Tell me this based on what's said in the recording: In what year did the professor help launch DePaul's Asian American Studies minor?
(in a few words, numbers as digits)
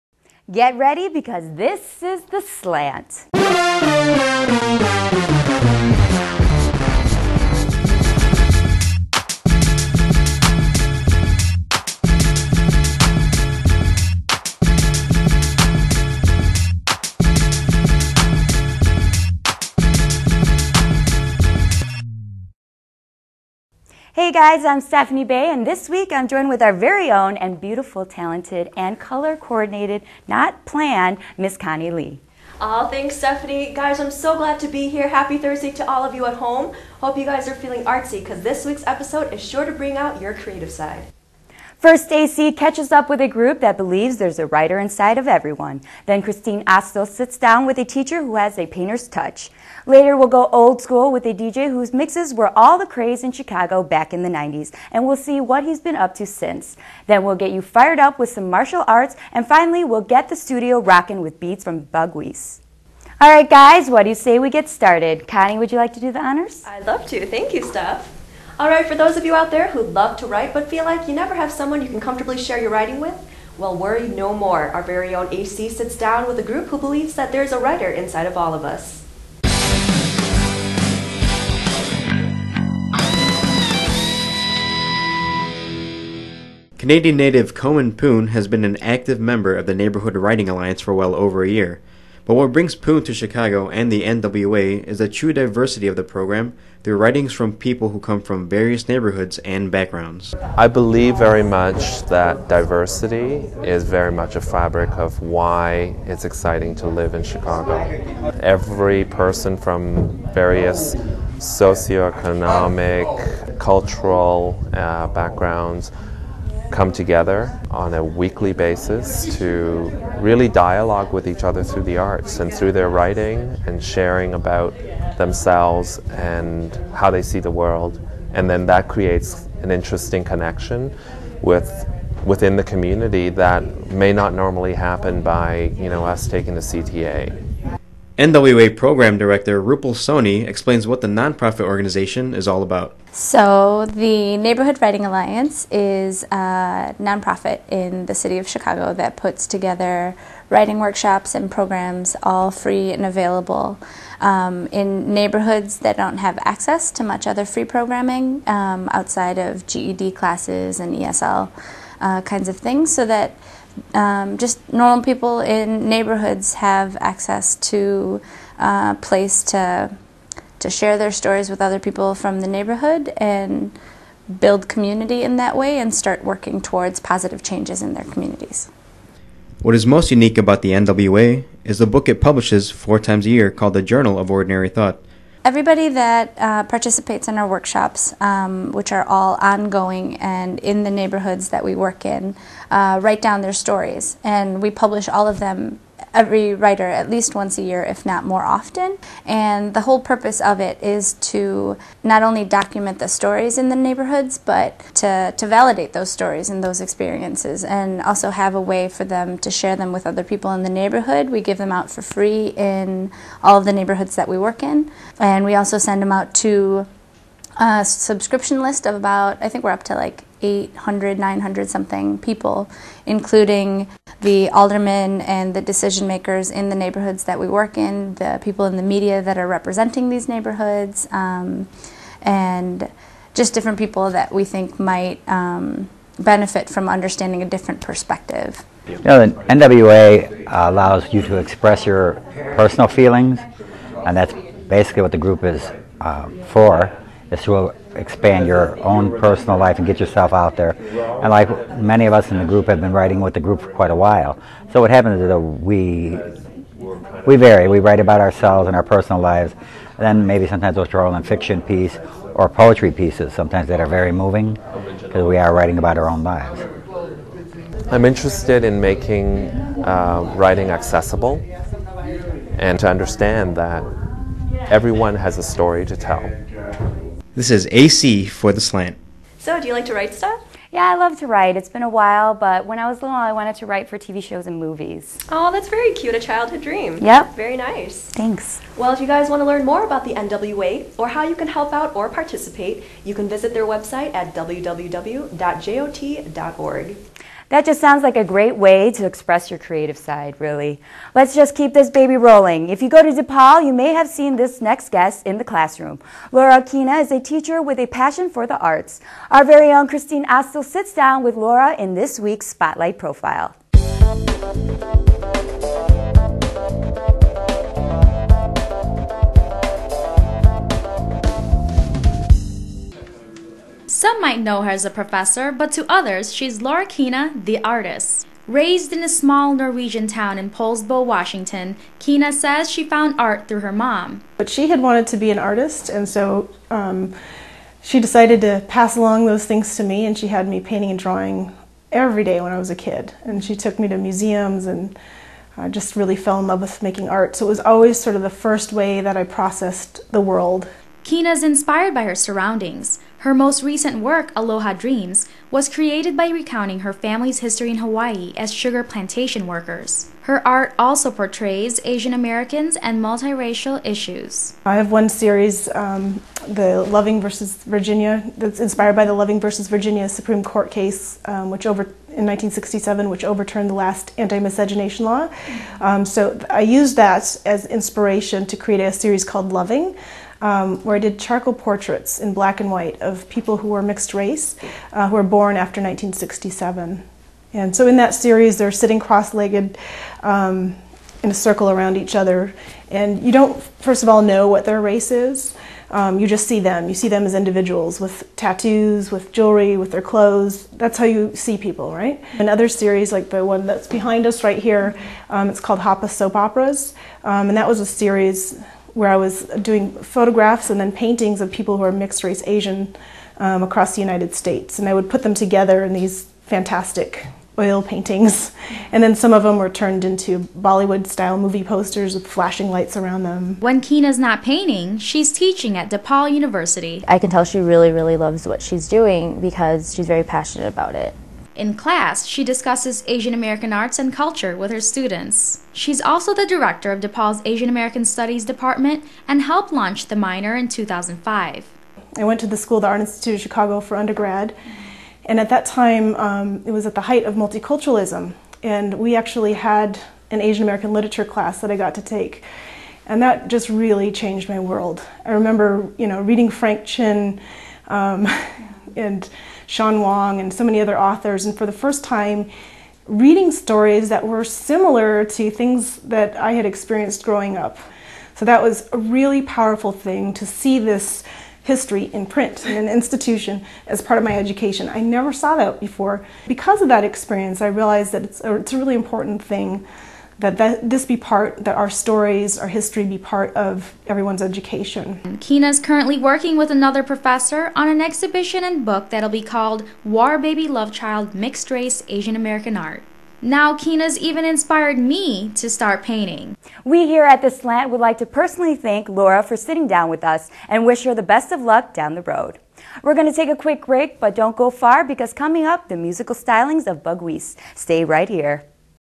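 2005.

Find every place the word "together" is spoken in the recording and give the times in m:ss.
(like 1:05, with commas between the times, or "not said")
1:56, 2:29, 6:55.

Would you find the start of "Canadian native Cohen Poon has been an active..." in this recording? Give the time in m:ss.
1:26.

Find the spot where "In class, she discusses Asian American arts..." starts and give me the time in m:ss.
7:11.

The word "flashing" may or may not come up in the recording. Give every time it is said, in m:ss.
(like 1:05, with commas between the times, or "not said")
7:02.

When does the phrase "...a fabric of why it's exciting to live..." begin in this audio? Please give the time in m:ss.
1:44.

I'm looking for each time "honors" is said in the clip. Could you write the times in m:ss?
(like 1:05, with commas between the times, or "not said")
1:06.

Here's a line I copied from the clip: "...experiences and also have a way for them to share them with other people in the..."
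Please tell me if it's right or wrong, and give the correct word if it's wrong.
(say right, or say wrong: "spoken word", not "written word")
right.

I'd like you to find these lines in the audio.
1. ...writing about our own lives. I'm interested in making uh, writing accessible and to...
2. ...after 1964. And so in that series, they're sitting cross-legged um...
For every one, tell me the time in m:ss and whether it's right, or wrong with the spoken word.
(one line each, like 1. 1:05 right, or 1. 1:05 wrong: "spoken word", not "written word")
1. 4:25 right
2. 6:25 wrong: "1967", not "1964".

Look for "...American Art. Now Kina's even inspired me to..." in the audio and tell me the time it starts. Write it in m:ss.
8:12.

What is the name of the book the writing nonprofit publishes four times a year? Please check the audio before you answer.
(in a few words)
The Journal of Ordinary Thought.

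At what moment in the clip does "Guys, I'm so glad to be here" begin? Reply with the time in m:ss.
0:33.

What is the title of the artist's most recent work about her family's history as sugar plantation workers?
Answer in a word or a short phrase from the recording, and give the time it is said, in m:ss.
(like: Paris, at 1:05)
Aloha Dreams, at 5:54.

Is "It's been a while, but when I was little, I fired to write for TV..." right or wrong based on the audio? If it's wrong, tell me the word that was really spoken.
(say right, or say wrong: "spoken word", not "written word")
wrong: "wanted", not "fired".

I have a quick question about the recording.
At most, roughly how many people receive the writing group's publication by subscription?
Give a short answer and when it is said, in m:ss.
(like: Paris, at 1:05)
900, at 3:41.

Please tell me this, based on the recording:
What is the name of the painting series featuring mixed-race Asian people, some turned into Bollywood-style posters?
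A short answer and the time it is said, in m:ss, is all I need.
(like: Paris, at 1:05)
Hapa Soap Operas, at 6:45.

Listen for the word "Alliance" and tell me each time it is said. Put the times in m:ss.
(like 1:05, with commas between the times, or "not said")
1:30, 2:25.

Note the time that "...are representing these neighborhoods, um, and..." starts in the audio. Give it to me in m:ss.
3:49.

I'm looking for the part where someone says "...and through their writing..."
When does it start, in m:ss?
2:02.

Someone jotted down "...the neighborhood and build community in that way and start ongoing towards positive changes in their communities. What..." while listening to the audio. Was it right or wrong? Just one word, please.
wrong.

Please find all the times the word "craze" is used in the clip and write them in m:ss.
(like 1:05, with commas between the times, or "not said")
0:52.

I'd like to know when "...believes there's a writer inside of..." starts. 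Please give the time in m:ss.
0:43.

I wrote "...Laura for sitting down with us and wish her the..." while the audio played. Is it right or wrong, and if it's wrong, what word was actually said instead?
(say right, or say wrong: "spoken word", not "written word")
right.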